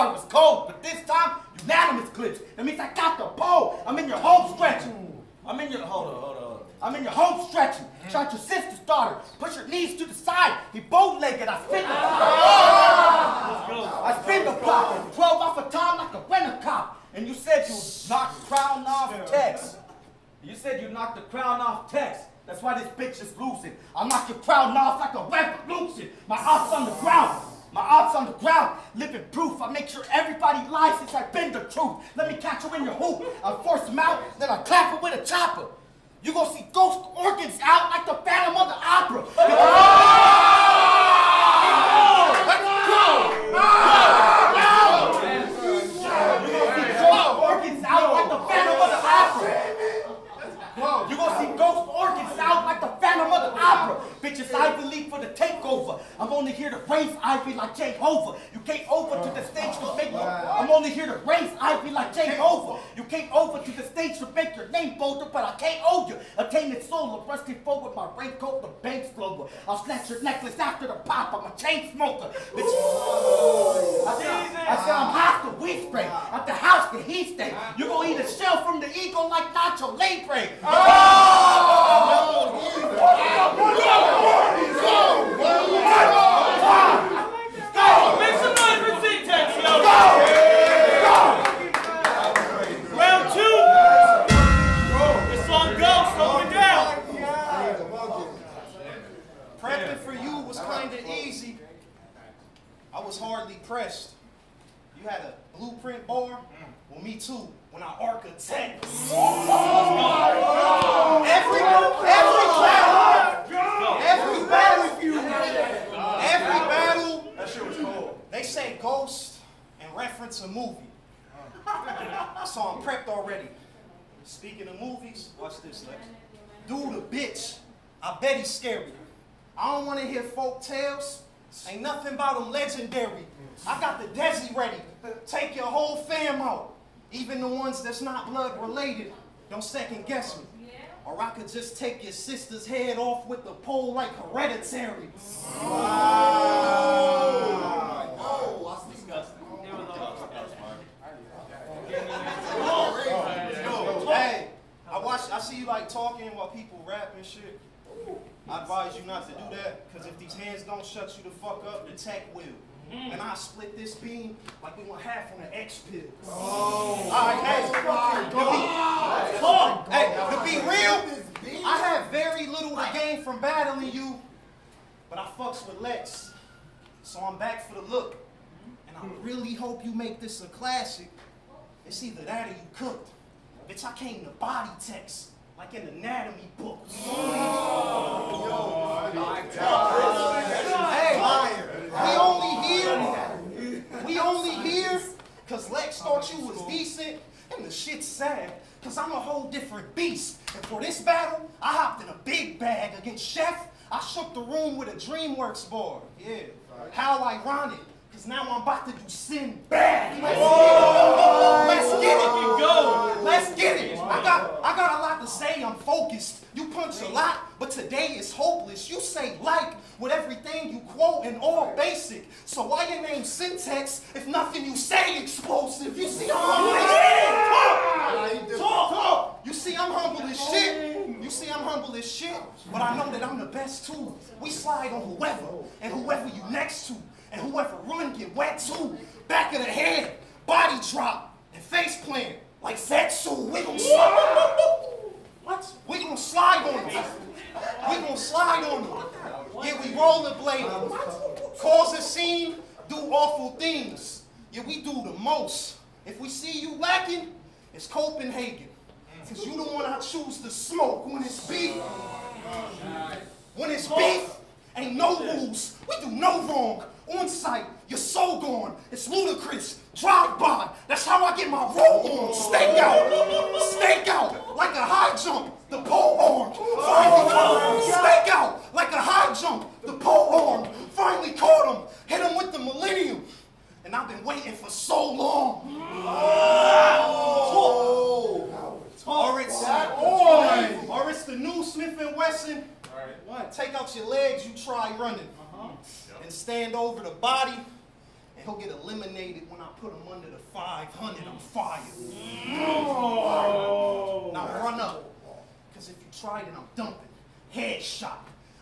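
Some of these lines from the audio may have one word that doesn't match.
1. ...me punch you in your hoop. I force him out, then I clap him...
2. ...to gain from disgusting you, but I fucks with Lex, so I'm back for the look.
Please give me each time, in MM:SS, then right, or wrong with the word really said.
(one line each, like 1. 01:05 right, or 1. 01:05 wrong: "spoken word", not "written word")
1. 00:32 wrong: "catch", not "punch"
2. 02:52 wrong: "battling", not "disgusting".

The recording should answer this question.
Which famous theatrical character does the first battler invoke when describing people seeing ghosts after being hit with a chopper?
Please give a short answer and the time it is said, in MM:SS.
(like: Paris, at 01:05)
Phantom of the Opera, at 00:38.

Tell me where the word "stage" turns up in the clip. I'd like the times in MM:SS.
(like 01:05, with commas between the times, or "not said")
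00:59, 01:03.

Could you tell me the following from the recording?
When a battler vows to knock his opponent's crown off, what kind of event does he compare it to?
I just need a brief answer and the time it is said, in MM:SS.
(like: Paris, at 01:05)
a revolution, at 00:25.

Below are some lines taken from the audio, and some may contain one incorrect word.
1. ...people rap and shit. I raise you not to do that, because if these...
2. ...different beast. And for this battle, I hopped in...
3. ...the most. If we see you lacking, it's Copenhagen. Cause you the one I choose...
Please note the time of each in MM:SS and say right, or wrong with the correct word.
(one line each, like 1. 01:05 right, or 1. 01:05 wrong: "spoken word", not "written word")
1. 02:36 wrong: "advise", not "raise"
2. 03:19 right
3. 04:15 right.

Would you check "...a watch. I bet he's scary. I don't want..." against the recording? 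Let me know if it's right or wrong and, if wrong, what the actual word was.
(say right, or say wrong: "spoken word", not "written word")
wrong: "bitch", not "watch".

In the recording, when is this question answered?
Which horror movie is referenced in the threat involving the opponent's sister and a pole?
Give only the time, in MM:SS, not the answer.
02:24.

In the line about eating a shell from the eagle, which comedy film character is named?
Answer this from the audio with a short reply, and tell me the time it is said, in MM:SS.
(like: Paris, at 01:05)
Nacho Libre, at 01:19.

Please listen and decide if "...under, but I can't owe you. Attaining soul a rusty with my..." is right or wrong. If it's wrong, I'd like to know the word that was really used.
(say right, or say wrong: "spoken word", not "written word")
wrong: "bolder", not "under".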